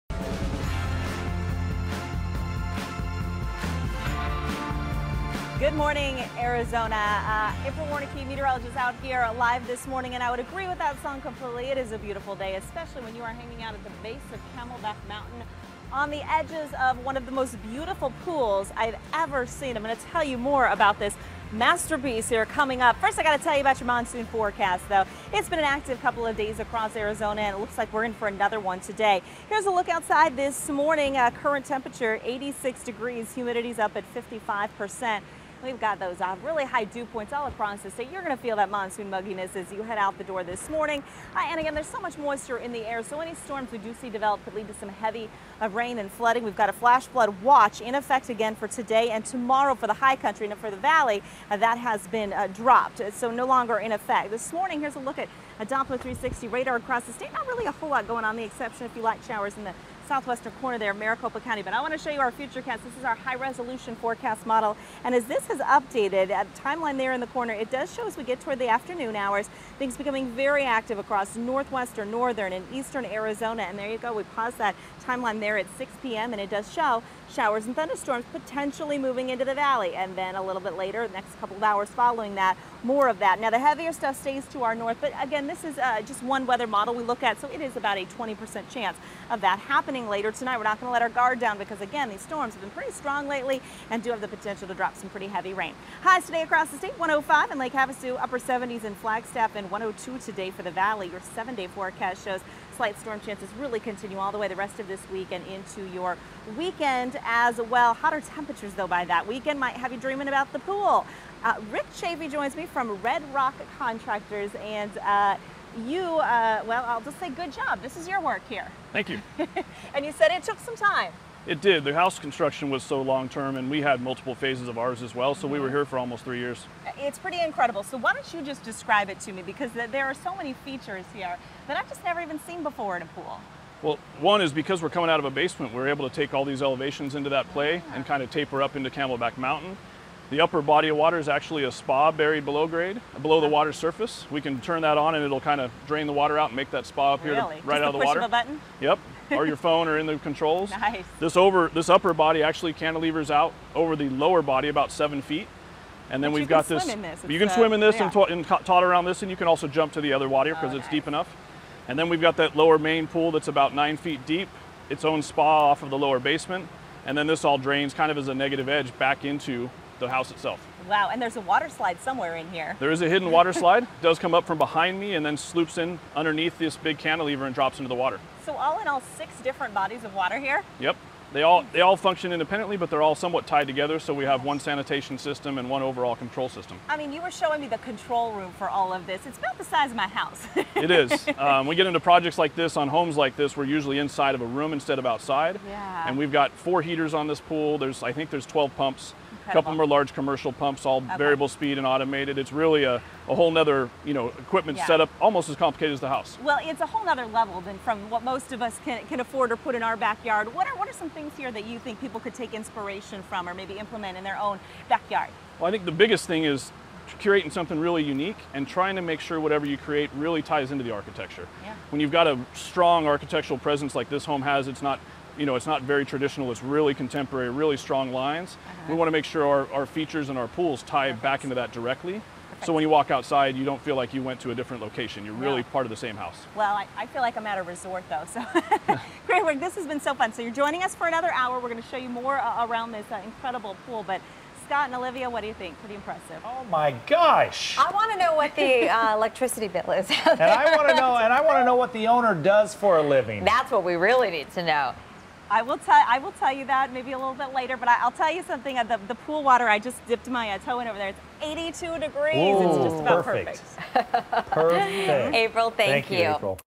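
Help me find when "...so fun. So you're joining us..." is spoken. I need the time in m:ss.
4:00.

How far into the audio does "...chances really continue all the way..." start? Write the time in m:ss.
1:43.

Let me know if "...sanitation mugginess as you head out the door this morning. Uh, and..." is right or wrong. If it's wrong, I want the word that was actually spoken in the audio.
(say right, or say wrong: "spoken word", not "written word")
wrong: "monsoon", not "sanitation".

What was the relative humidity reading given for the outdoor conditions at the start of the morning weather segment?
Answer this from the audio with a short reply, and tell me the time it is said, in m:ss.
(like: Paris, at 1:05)
55 percent, at 0:34.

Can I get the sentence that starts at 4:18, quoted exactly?
Uh, the, the pool water I just dipped my uh, toe in over there.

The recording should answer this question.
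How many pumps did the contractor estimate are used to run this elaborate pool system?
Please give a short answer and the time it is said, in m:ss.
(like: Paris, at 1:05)
12, at 3:18.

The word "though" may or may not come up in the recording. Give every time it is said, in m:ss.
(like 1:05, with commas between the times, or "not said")
0:24, 1:48, 3:58.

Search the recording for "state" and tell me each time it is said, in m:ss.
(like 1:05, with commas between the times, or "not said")
0:37, 0:57, 1:36.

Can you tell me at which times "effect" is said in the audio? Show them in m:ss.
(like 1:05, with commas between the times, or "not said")
0:47, 0:53.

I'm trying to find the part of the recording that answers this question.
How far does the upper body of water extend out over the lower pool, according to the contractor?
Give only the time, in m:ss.
2:34.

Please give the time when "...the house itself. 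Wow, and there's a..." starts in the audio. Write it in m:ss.
2:50.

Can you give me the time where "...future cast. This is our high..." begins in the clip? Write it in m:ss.
1:02.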